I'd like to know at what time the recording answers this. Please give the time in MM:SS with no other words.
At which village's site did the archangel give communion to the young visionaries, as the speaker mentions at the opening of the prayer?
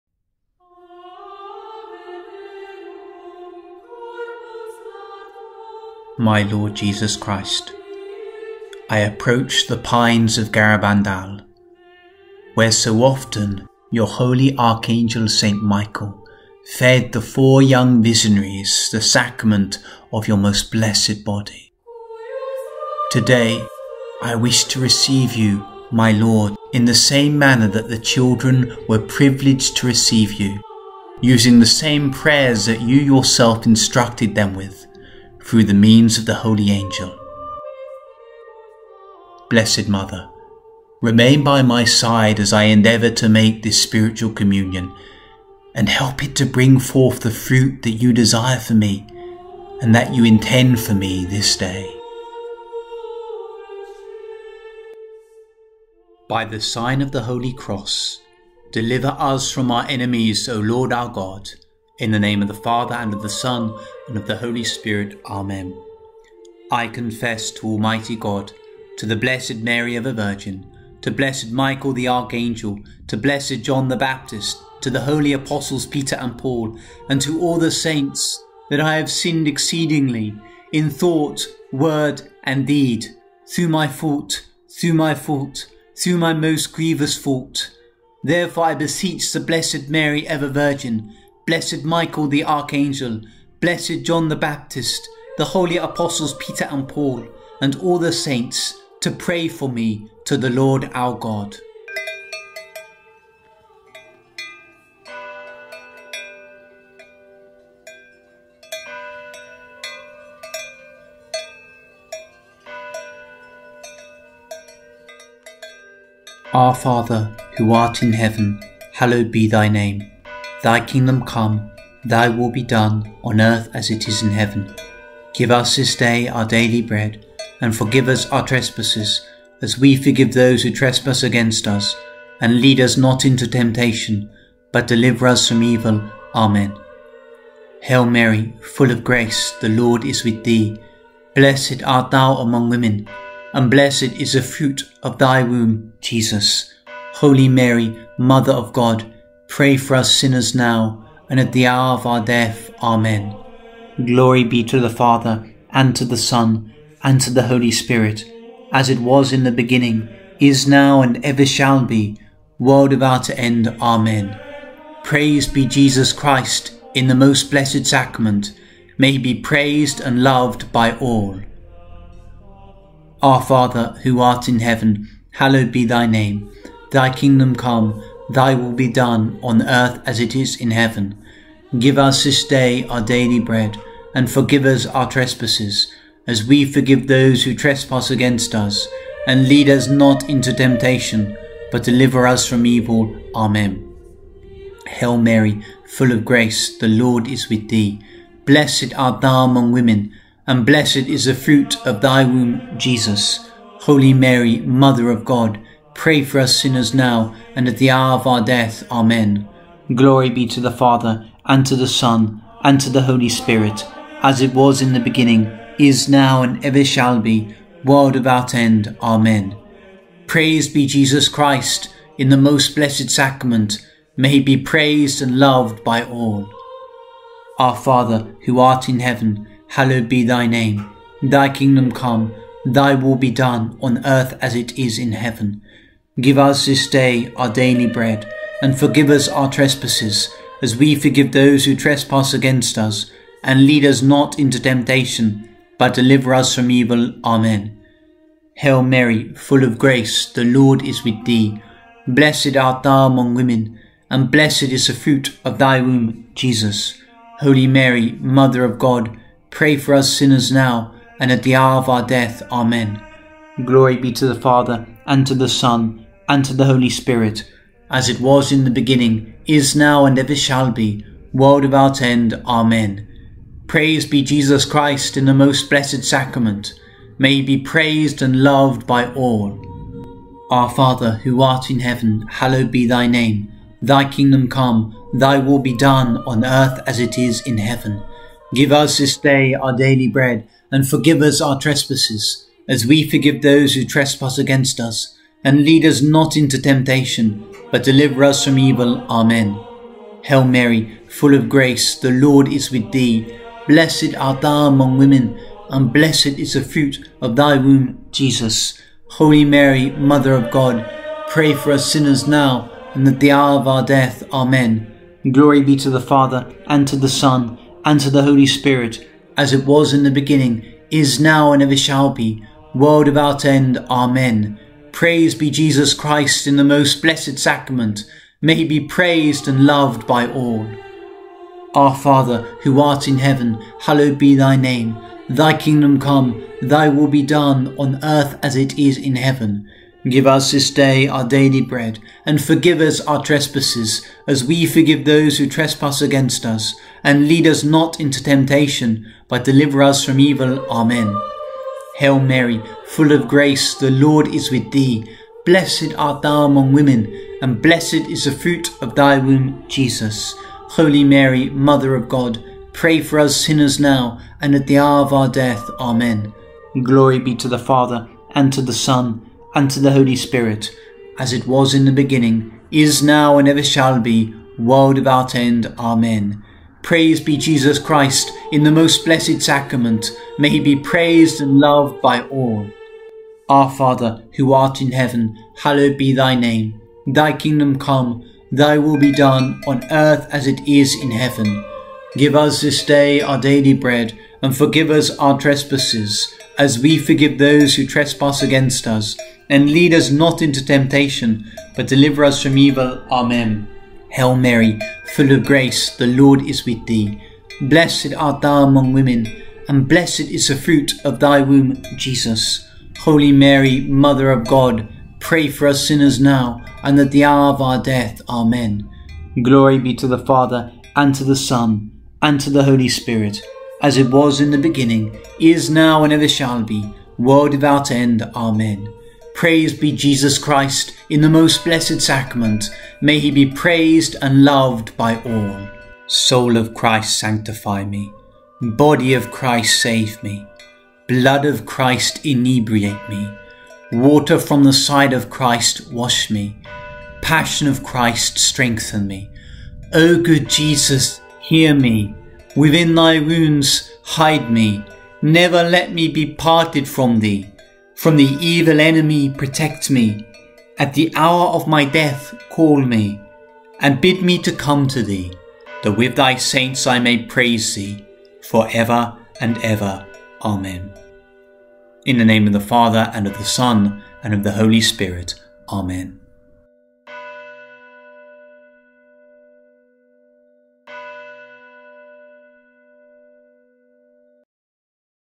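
00:10.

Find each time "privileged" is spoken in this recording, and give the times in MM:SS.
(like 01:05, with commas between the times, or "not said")
00:28.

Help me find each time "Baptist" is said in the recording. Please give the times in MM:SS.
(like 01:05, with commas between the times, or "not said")
01:13, 01:34.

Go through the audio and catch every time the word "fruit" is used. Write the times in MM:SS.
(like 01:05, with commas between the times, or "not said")
00:47, 02:24, 03:21, 04:14, 05:06, 05:58, 06:50.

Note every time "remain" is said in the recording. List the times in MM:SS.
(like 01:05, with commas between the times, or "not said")
00:41.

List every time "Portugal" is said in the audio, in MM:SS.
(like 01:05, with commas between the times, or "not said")
not said.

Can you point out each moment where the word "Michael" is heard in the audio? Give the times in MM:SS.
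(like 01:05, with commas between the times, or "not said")
00:15, 01:11, 01:31.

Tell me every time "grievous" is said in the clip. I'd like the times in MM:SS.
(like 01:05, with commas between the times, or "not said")
01:26.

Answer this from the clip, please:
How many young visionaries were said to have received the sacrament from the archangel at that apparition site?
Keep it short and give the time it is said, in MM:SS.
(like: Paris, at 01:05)
4, at 00:17.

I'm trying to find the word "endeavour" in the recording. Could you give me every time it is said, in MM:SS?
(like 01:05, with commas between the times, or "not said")
00:42.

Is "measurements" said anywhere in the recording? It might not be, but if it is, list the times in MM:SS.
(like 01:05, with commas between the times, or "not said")
not said.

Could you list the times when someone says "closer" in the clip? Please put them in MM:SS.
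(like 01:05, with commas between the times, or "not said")
not said.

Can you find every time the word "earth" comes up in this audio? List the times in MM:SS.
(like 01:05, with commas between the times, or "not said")
02:03, 02:59, 03:54, 04:46, 05:38, 06:29.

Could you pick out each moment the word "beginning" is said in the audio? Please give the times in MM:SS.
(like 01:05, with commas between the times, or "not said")
02:39, 03:34, 04:28, 05:20, 06:11, 07:04.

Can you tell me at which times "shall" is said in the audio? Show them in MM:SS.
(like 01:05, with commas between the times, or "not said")
02:41, 03:36, 04:30, 05:21, 06:13, 07:06.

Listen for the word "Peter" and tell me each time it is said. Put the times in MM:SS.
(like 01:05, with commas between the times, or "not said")
01:15, 01:36.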